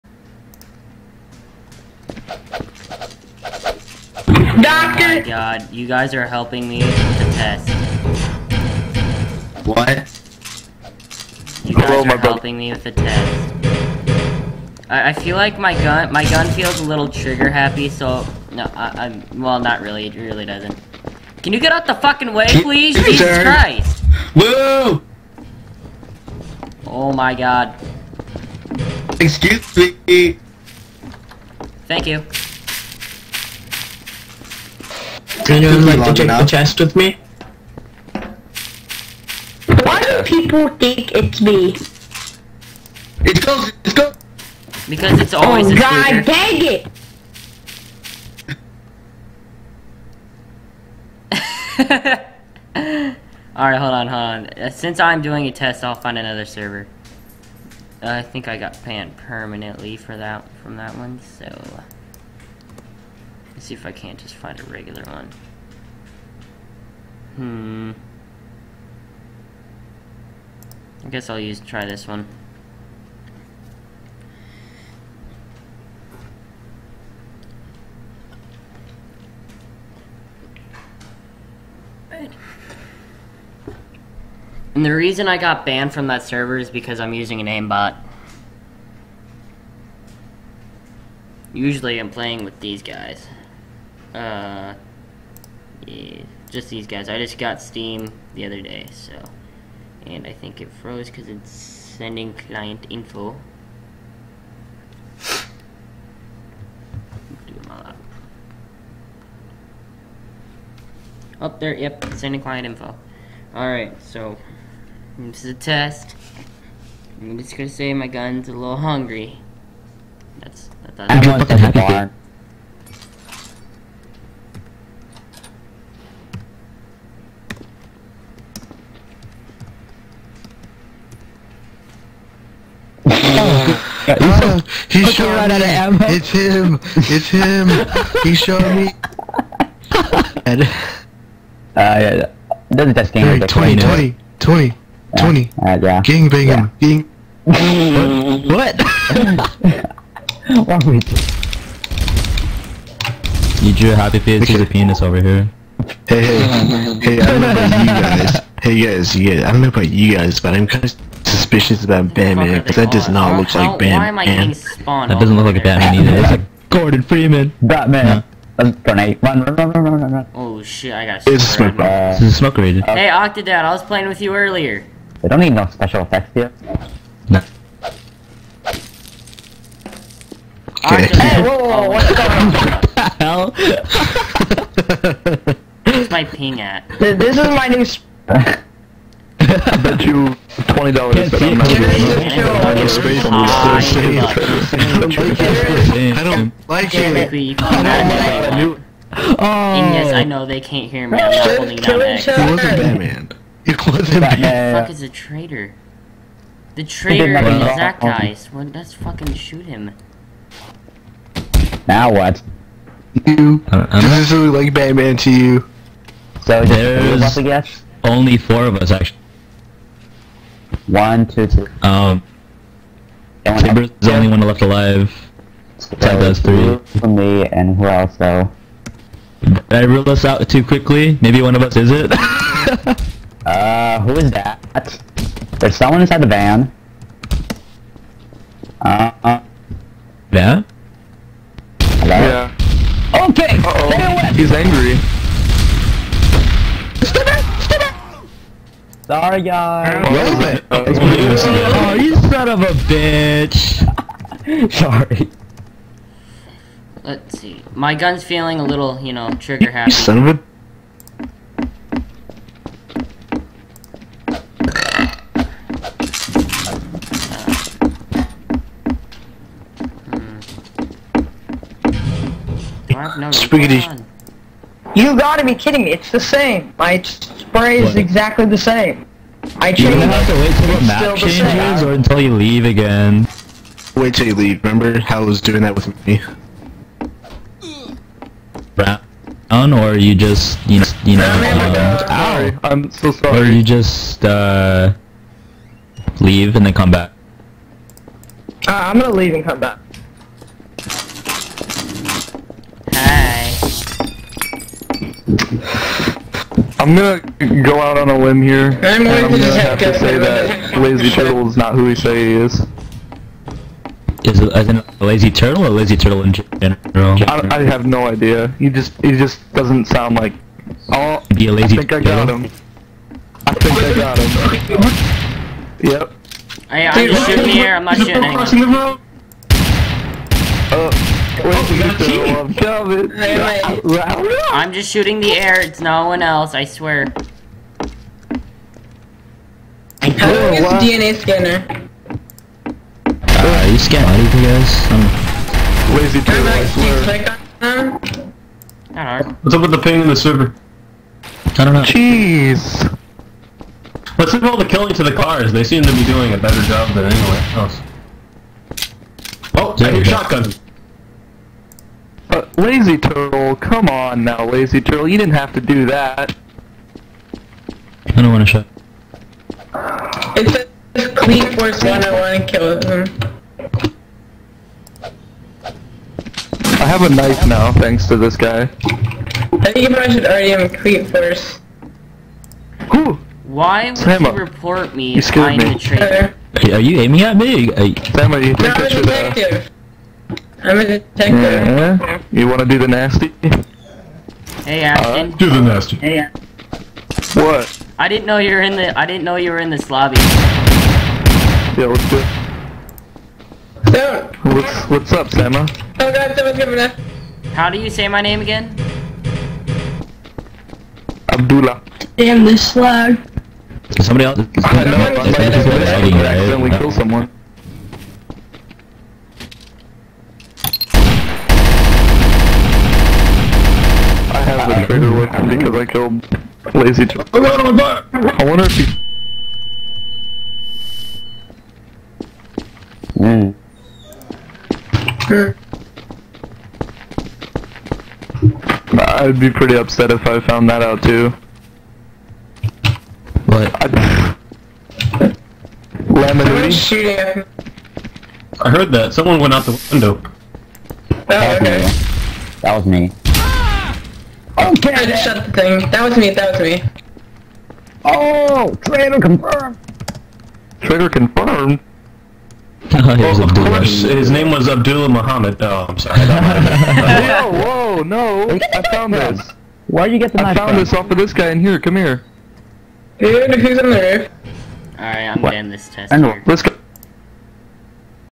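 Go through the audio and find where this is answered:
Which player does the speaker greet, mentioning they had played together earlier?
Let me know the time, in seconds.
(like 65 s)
173 s.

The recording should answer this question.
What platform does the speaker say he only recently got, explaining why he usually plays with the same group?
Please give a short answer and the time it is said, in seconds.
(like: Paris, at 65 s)
Steam, at 97 s.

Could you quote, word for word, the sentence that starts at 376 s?
I have a knife now, thanks to this guy.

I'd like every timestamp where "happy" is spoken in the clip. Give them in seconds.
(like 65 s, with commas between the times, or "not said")
17 s, 121 s, 153 s, 259 s.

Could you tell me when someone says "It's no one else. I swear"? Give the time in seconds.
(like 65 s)
335 s.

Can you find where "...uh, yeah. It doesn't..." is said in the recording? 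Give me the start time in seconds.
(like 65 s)
141 s.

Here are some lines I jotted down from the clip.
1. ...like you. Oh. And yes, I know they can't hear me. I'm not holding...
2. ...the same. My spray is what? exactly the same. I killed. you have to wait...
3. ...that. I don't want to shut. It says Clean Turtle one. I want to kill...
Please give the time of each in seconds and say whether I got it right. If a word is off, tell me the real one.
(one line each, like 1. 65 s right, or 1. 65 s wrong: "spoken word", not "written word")
1. 198 s right
2. 276 s wrong: "changed", not "killed"
3. 365 s wrong: "Force", not "Turtle".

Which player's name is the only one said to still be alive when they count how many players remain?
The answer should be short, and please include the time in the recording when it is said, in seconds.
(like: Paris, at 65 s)
Timbers, at 223 s.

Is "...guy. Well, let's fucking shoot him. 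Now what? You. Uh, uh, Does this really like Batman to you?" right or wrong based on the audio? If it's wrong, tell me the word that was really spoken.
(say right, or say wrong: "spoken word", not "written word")
right.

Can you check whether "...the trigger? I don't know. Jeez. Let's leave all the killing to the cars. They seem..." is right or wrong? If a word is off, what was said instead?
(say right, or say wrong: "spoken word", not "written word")
wrong: "server", not "trigger".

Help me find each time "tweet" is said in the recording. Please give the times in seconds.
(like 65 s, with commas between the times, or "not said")
not said.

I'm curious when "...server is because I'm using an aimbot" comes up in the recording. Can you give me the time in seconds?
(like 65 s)
86 s.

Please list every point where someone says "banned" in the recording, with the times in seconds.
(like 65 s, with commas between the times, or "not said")
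58 s, 85 s.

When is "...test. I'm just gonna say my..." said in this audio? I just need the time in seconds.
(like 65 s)
115 s.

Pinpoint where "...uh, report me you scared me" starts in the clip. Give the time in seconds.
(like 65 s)
384 s.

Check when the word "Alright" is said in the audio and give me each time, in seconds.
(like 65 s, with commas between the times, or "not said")
53 s, 113 s, 474 s.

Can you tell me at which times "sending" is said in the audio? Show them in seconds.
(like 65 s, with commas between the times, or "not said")
101 s, 112 s.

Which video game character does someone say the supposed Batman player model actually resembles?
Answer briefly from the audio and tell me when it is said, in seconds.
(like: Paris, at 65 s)
Gordon Freeman, at 166 s.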